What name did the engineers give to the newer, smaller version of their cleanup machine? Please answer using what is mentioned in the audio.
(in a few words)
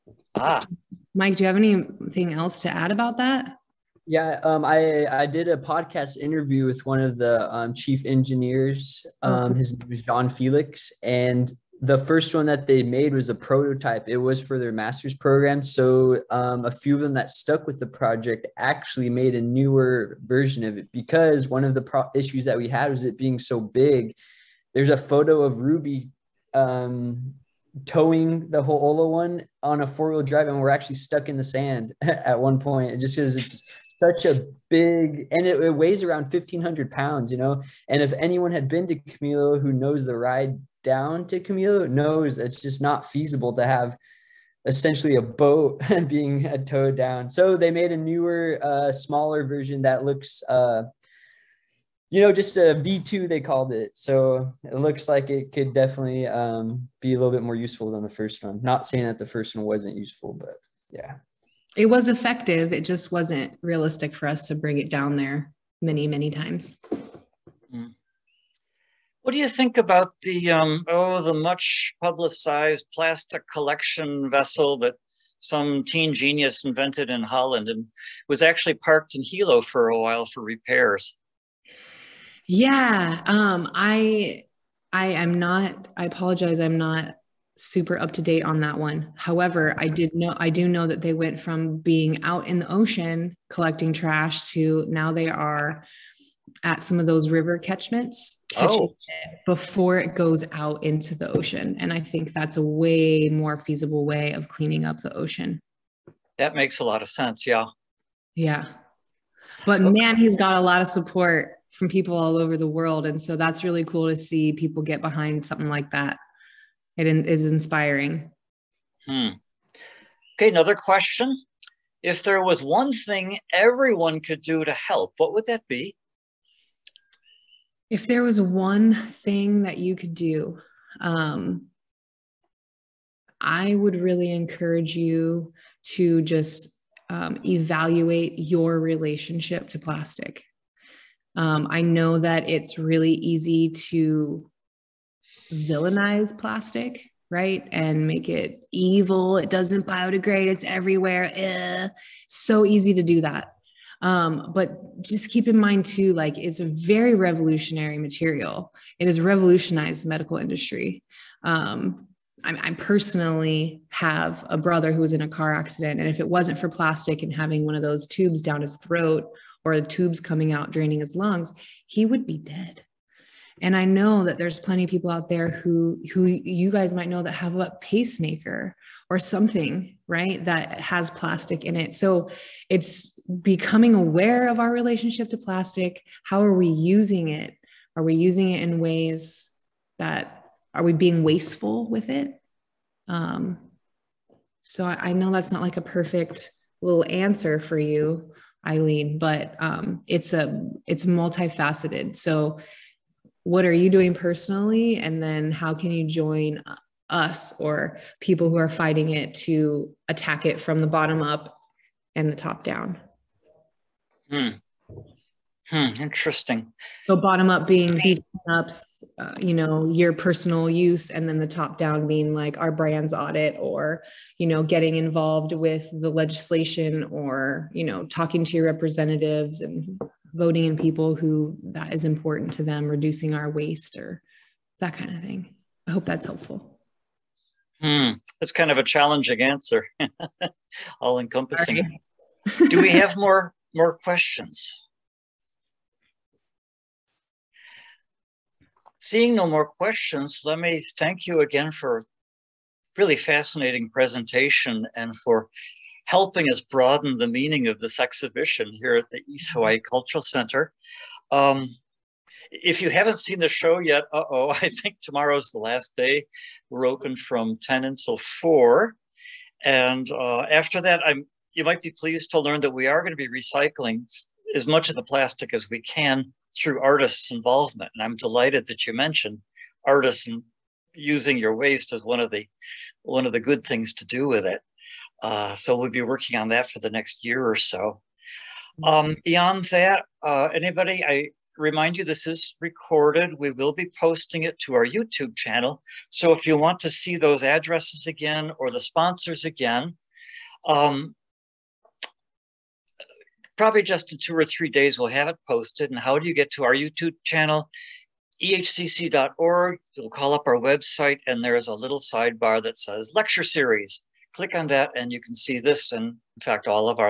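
V2.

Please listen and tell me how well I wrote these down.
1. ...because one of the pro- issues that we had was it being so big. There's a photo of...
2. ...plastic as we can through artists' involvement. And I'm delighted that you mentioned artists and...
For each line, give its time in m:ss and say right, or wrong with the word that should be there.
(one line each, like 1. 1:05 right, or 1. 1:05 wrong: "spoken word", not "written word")
1. 0:20 right
2. 4:35 right.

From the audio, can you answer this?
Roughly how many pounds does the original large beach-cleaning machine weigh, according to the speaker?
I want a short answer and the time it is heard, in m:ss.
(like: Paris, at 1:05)
1500, at 0:36.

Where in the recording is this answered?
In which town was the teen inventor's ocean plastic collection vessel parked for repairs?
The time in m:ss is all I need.
1:19.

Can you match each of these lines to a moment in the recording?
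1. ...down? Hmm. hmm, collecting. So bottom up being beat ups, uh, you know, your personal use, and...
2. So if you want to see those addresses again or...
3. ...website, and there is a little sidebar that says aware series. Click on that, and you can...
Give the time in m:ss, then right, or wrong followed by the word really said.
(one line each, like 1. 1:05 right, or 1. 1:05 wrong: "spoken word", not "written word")
1. 3:32 wrong: "interesting", not "collecting"
2. 4:56 right
3. 5:10 wrong: "lecture", not "aware".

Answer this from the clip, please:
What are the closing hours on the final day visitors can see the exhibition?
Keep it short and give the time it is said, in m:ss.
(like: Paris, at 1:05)
10 until 4, at 4:27.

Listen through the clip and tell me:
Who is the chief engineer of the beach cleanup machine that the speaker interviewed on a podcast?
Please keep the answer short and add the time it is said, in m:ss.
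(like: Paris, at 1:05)
John Felix, at 0:10.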